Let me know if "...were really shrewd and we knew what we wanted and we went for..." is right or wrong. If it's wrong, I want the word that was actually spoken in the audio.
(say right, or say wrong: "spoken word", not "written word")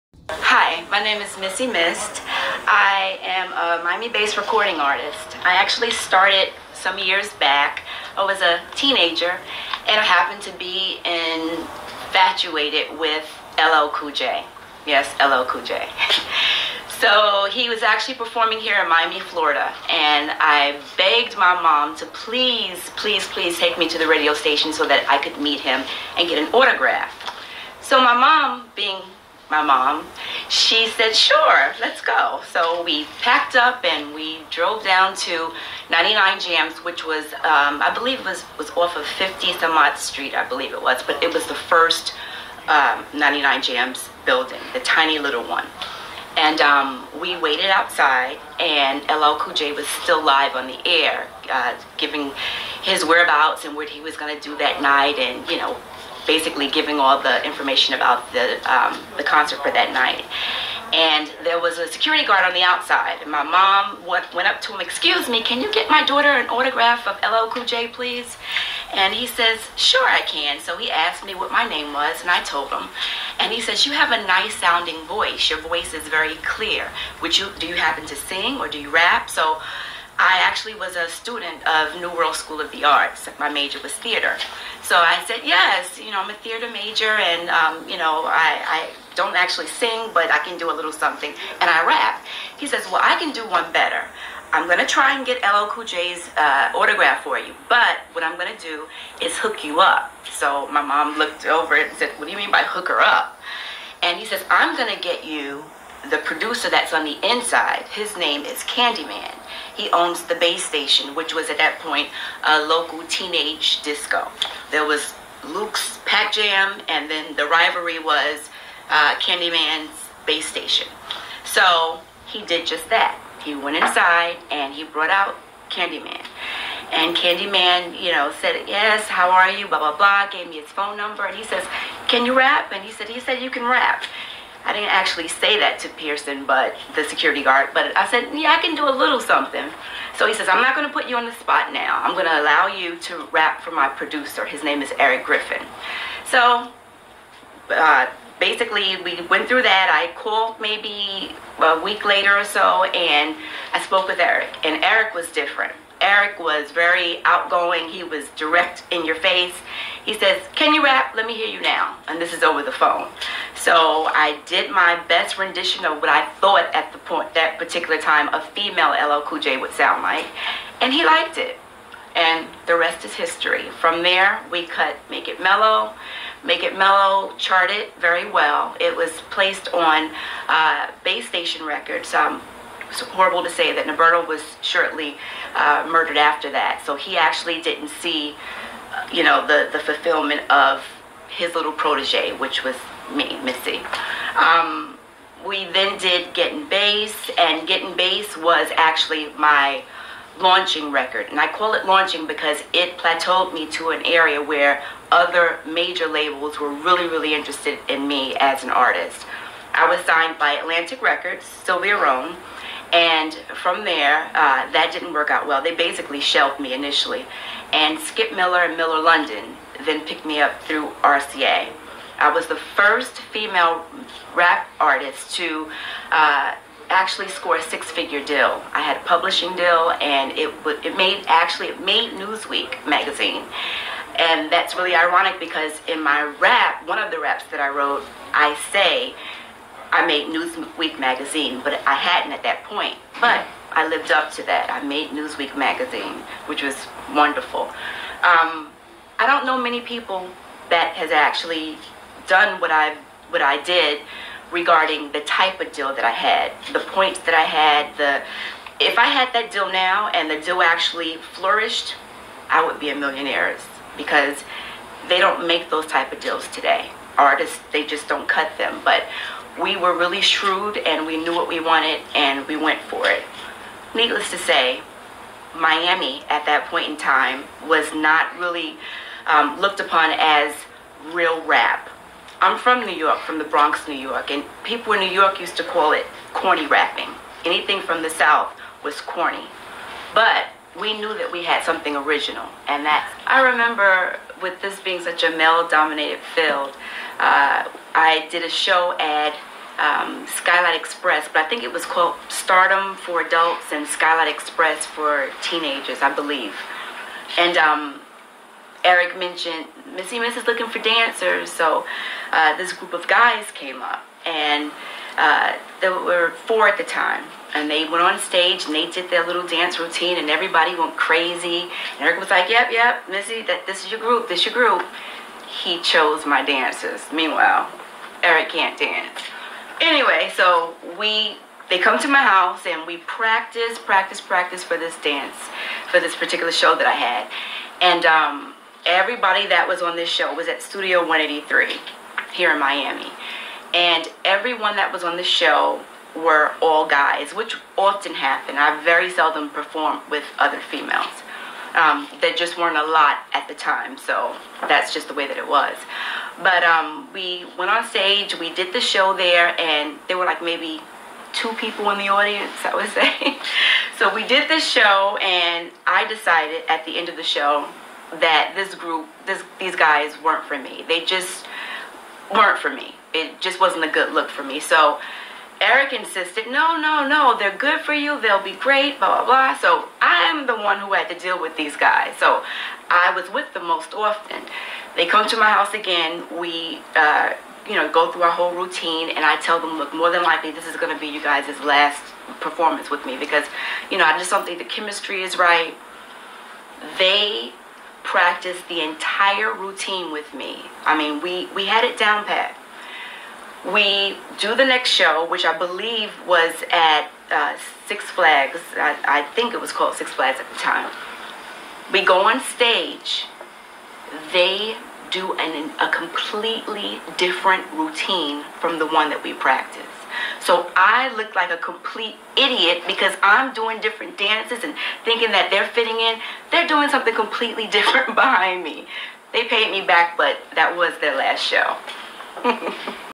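right.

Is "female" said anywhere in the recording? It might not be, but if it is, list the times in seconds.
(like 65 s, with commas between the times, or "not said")
168 s, 223 s, 350 s.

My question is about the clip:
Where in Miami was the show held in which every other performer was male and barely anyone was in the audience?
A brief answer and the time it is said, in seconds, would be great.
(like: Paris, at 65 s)
Studio 183, at 340 s.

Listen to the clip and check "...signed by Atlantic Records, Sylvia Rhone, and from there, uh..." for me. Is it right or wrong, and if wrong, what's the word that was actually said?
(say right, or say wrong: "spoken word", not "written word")
right.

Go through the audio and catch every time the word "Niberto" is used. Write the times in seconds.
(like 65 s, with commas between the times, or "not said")
183 s.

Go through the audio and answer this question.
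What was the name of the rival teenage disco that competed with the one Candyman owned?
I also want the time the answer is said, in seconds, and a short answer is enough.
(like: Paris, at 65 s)
Luke's Pac Jam, at 115 s.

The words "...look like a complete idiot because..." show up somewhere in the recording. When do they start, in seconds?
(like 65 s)
421 s.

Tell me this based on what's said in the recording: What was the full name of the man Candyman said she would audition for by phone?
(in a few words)
Eric Griffin.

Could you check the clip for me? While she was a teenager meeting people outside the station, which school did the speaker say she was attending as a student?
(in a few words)
New World School of the Arts.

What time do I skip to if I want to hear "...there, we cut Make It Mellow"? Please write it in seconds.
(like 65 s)
174 s.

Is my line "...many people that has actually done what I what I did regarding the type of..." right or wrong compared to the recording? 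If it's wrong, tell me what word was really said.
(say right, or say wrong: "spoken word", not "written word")
right.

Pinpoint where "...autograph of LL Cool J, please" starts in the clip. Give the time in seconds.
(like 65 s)
66 s.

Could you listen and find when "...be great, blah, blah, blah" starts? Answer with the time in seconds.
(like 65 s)
378 s.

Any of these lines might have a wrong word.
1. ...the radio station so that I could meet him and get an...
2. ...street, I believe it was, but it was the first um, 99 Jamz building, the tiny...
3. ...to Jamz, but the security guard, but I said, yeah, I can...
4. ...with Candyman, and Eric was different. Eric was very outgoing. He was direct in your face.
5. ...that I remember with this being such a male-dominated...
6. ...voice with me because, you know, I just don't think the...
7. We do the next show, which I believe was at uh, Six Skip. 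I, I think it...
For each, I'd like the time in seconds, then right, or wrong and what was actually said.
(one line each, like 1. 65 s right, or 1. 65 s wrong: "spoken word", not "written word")
1. 23 s right
2. 39 s right
3. 135 s wrong: "Pearson", not "Jamz"
4. 154 s wrong: "Eric", not "Candyman"
5. 292 s right
6. 392 s wrong: "performance", not "voice"
7. 403 s wrong: "Flags", not "Skip".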